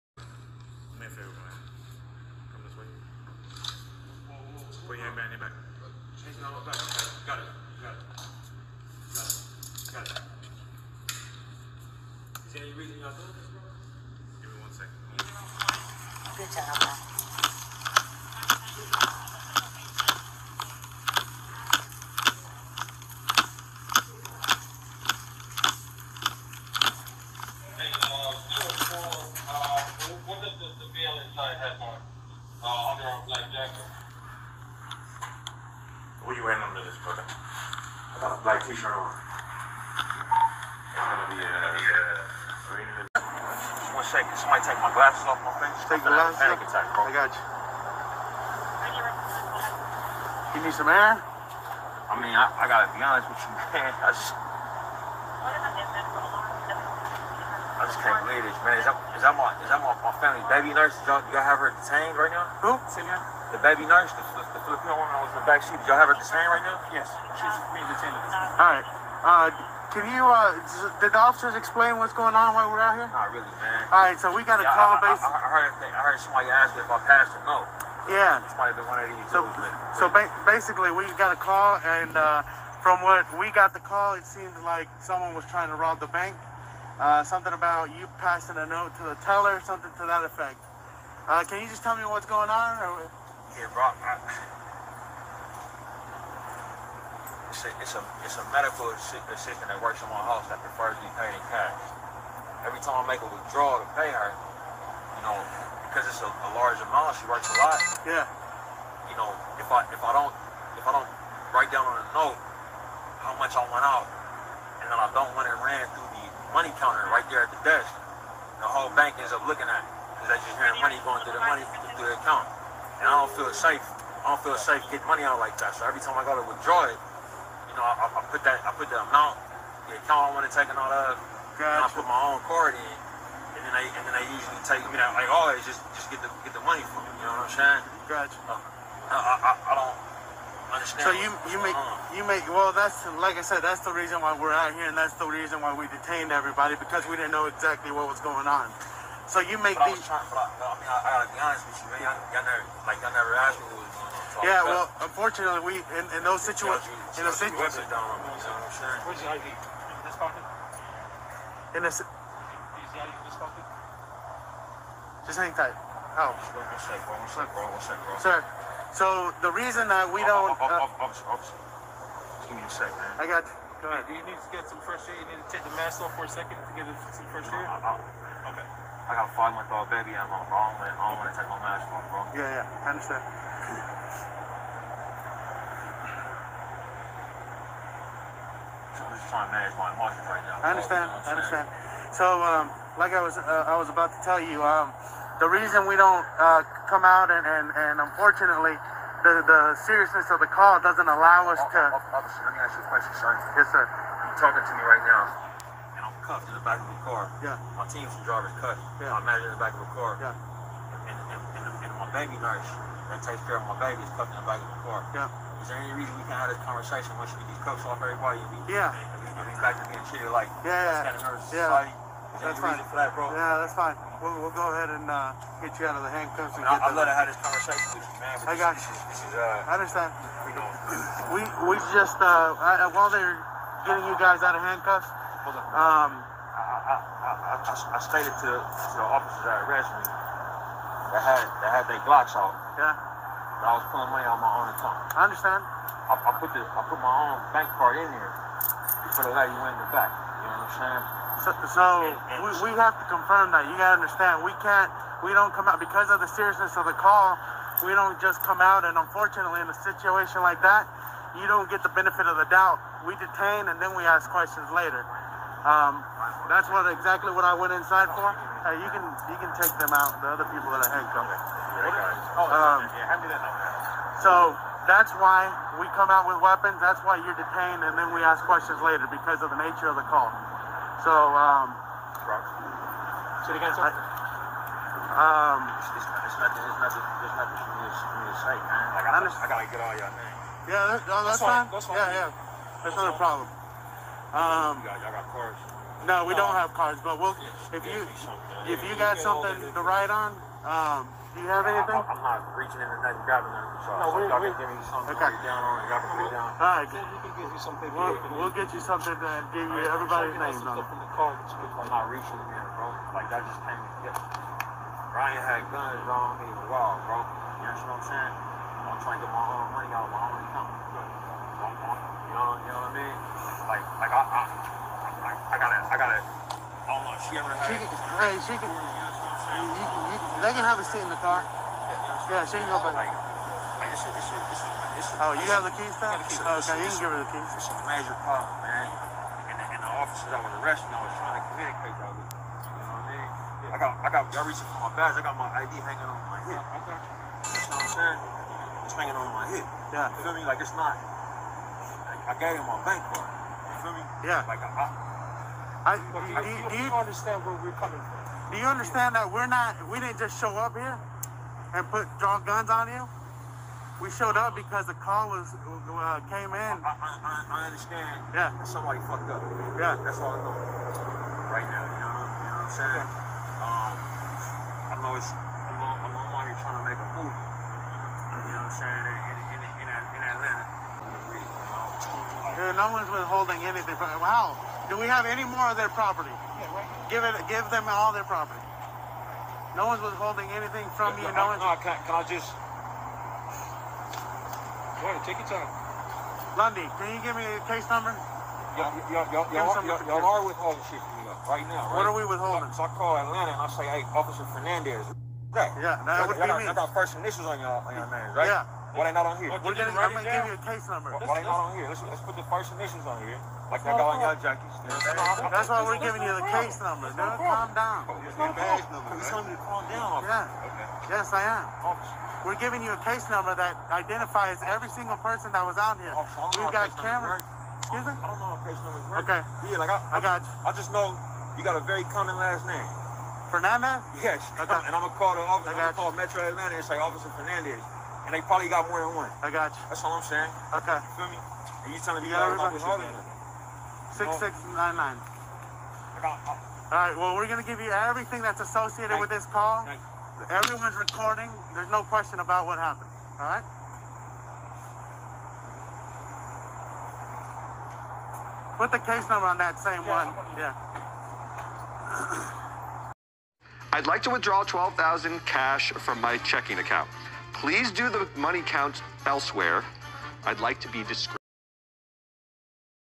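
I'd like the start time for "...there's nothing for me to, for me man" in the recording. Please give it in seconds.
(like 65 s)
287 s.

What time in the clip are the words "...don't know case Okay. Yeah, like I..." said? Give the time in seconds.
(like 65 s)
428 s.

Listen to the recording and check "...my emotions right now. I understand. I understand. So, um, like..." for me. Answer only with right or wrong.
right.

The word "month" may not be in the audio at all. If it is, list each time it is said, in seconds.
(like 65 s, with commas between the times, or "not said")
179 s.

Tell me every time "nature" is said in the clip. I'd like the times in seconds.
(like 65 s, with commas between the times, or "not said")
279 s.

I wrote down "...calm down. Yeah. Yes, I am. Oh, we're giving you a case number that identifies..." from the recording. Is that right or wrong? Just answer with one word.
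right.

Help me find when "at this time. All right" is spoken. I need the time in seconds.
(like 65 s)
68 s.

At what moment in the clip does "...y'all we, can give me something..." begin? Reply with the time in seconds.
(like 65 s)
304 s.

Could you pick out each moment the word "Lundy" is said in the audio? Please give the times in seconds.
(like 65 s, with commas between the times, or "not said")
396 s.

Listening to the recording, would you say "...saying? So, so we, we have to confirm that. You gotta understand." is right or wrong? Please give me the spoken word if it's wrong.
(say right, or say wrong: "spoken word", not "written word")
right.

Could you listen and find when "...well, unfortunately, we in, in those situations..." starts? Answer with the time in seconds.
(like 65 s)
154 s.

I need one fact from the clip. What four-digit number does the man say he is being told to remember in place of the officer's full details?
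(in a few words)
6699.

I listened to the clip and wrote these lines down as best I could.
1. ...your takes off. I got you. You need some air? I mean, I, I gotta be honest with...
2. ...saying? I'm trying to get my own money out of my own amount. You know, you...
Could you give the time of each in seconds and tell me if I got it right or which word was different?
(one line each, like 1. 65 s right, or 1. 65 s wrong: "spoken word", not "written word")
1. 46 s wrong: "glasses", not "takes"
2. 318 s wrong: "account", not "amount".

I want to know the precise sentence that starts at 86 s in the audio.
Uh, something about you passing a note to the teller, something to that effect.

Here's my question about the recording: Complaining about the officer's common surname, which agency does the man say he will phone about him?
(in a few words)
Metro Atlanta.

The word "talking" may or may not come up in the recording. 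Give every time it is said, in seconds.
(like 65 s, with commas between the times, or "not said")
204 s.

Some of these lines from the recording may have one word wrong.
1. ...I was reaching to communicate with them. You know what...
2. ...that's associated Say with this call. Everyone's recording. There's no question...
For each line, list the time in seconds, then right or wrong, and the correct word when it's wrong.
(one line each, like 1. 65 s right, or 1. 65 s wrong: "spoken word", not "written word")
1. 340 s wrong: "trying", not "reaching"
2. 448 s wrong: "Thank", not "Say".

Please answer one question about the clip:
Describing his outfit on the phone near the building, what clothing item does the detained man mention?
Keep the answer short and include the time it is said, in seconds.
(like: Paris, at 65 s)
black t-shirt, at 38 s.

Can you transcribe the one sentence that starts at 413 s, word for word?
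Like y'all got on y'all junkies.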